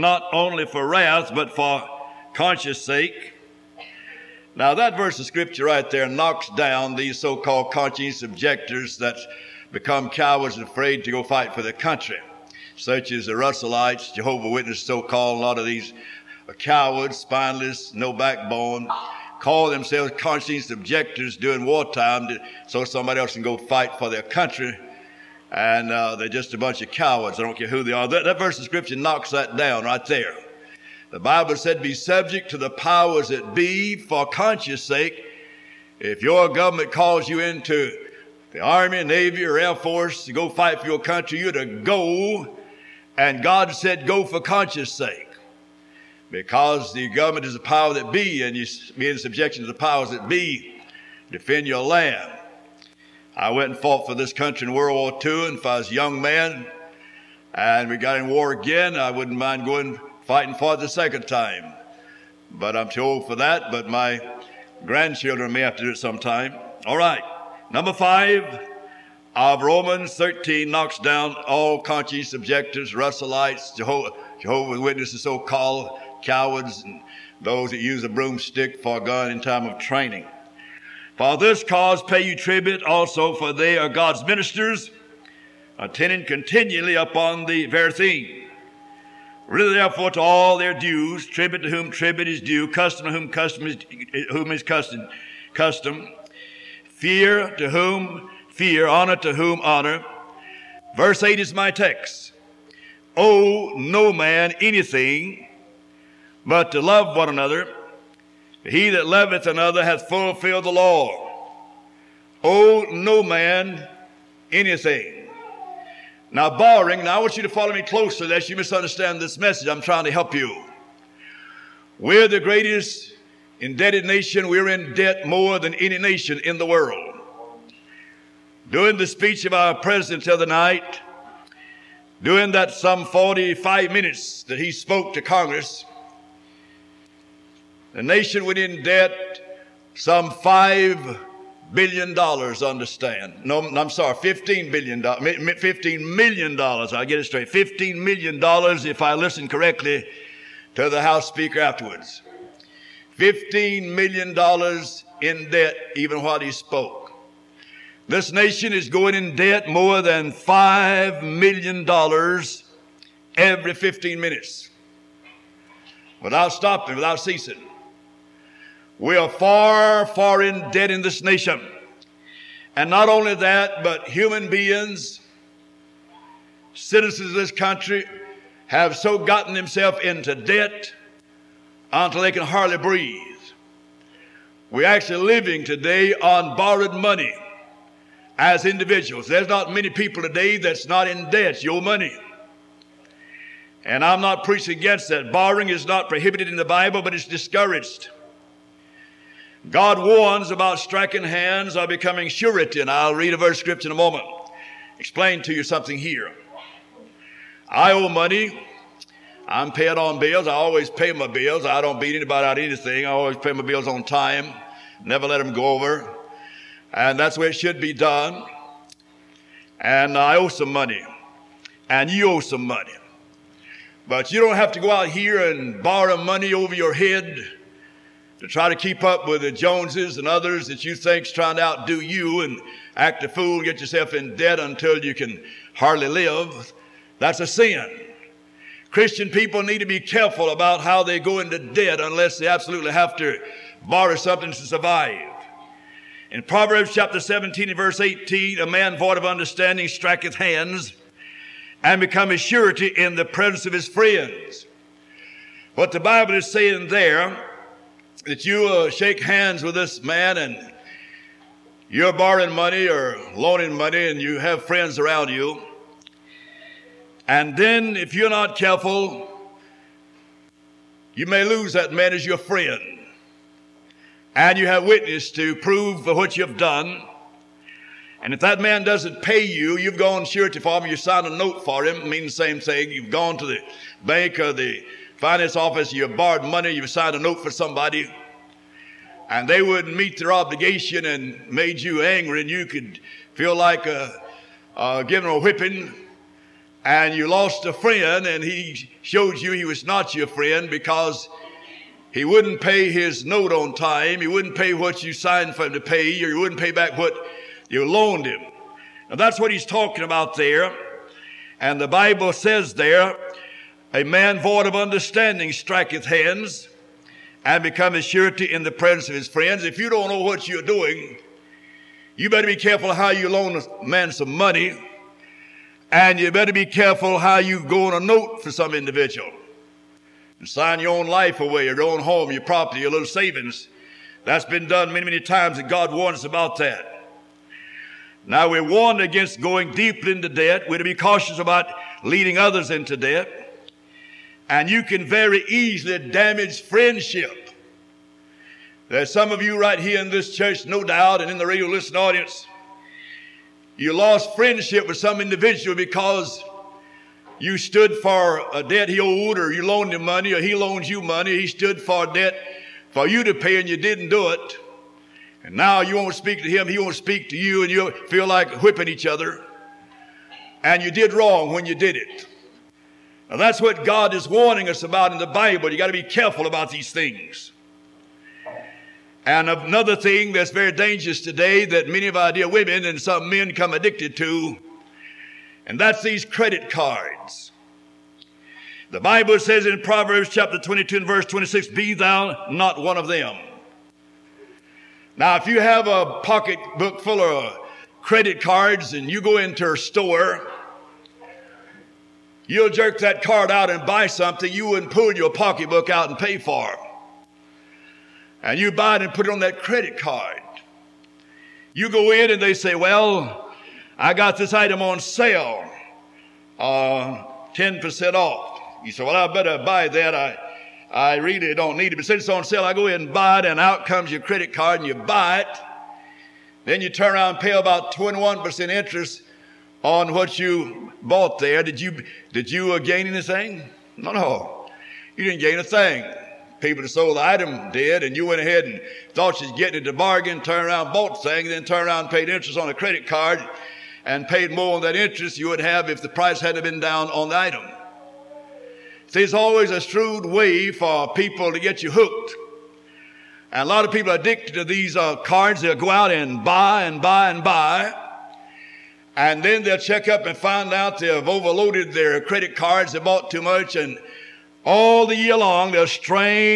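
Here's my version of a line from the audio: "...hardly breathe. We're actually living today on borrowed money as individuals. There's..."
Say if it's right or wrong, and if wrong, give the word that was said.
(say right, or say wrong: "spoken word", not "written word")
right.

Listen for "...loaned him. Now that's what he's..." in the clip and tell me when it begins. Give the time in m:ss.
5:07.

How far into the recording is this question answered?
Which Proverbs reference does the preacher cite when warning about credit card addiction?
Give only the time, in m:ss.
6:29.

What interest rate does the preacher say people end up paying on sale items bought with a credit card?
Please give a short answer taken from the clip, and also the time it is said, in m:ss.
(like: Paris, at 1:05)
21%, at 7:07.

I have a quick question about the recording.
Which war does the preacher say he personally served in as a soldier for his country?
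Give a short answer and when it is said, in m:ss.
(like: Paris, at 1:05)
World War II, at 0:54.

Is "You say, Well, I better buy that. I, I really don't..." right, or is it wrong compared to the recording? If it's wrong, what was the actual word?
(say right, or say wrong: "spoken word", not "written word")
right.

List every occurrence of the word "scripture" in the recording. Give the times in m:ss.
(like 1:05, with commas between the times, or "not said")
0:05, 0:28, 3:23.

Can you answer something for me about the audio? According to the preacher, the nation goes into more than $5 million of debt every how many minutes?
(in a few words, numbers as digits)
15 minutes.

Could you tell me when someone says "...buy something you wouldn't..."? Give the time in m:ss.
6:43.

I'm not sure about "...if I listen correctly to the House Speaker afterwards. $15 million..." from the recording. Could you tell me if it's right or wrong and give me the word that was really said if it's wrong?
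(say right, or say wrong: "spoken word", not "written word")
right.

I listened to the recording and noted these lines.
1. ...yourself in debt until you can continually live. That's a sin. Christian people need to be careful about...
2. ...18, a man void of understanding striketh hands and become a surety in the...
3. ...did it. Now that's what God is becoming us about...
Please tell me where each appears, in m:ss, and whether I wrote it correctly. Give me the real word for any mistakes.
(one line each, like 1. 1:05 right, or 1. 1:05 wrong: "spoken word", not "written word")
1. 3:53 wrong: "hardly", not "continually"
2. 4:07 right
3. 6:11 wrong: "warning", not "becoming".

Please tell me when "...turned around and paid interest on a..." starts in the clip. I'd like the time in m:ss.
7:21.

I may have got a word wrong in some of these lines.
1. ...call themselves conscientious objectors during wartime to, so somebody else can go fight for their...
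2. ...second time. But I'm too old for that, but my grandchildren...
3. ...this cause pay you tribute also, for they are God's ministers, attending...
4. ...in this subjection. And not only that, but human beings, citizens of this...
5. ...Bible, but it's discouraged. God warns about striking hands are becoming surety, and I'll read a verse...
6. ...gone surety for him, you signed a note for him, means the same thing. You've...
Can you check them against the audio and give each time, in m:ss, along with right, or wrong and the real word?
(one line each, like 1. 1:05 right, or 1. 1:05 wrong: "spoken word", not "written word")
1. 0:19 right
2. 1:00 right
3. 1:21 right
4. 2:50 wrong: "nation", not "subjection"
5. 3:16 right
6. 4:39 right.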